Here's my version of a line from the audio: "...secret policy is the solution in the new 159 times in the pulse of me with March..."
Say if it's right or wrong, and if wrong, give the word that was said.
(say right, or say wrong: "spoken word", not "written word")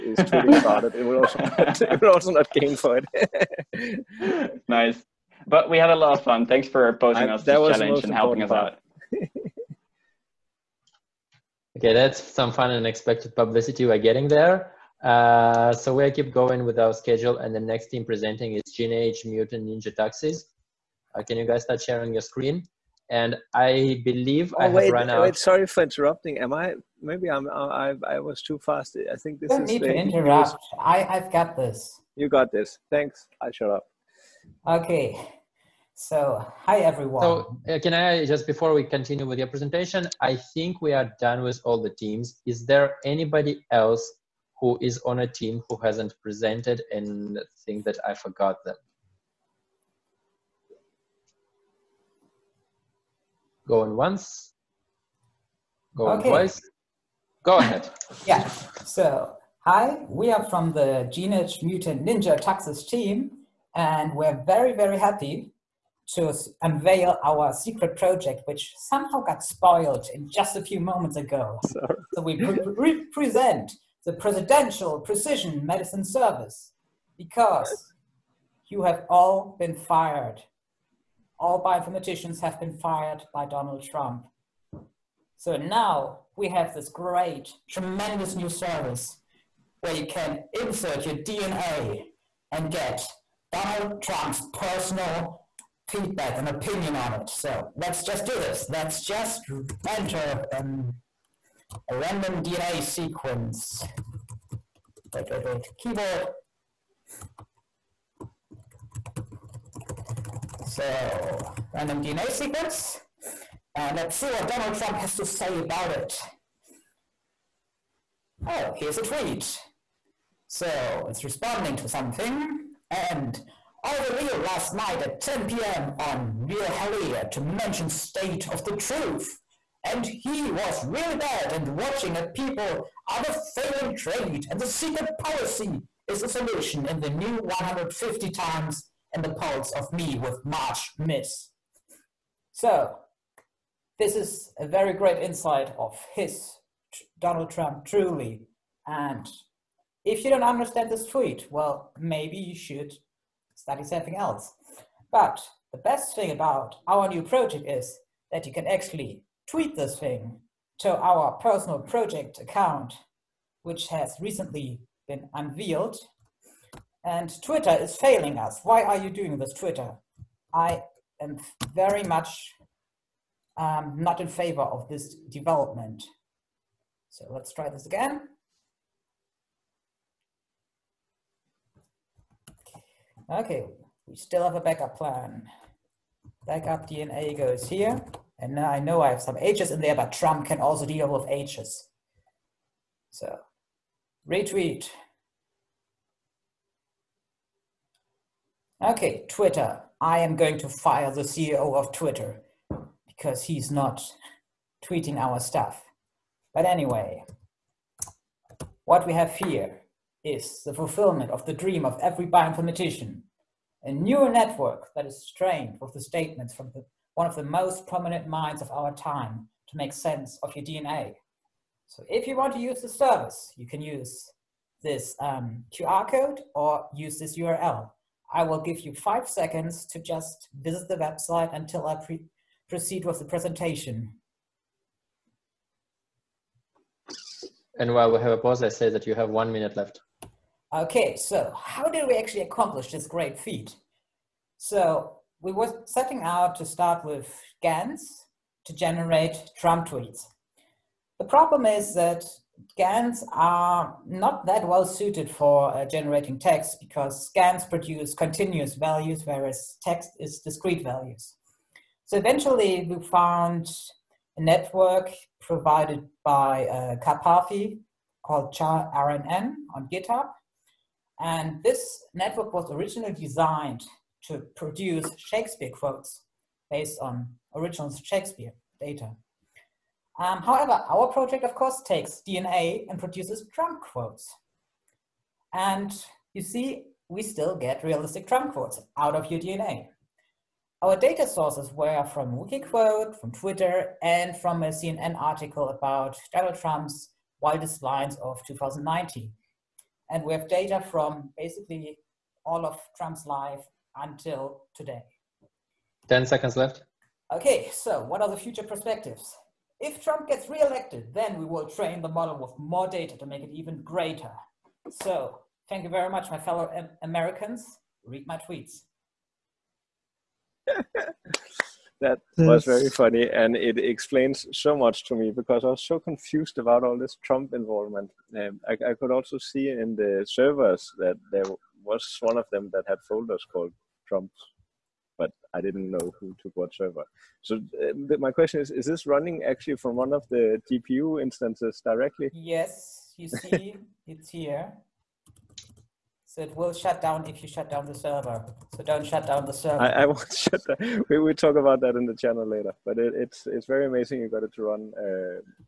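wrong: "150", not "159".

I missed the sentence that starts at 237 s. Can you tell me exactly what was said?
And while we have a pause, I say that you have one minute left.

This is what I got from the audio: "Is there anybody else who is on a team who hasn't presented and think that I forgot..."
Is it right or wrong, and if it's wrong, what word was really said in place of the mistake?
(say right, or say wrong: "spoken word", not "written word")
right.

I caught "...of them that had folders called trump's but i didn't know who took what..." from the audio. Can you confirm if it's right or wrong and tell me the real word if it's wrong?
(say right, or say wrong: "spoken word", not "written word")
right.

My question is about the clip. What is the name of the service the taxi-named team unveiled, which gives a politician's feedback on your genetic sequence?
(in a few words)
Presidential Precision Medicine Service.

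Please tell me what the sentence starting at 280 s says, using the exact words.
Um, however, our project, of course, takes DNA and produces Trump quotes.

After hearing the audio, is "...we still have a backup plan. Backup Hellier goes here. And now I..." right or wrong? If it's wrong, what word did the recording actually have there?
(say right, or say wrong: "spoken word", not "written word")
wrong: "DNA", not "Hellier".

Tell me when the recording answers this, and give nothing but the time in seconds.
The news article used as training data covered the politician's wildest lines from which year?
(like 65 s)
298 s.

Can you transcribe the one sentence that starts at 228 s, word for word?
I will give you five seconds to just visit the website until I pre proceed with the presentation.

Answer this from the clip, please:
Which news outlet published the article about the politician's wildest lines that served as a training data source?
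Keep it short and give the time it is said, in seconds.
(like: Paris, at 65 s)
CNN, at 294 s.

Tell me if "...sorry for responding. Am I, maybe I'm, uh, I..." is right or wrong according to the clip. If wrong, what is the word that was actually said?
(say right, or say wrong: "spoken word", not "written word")
wrong: "interrupting", not "responding".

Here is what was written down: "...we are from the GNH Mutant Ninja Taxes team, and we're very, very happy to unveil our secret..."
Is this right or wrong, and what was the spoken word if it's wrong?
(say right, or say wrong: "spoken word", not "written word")
right.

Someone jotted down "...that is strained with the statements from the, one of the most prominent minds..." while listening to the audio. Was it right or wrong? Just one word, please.
right.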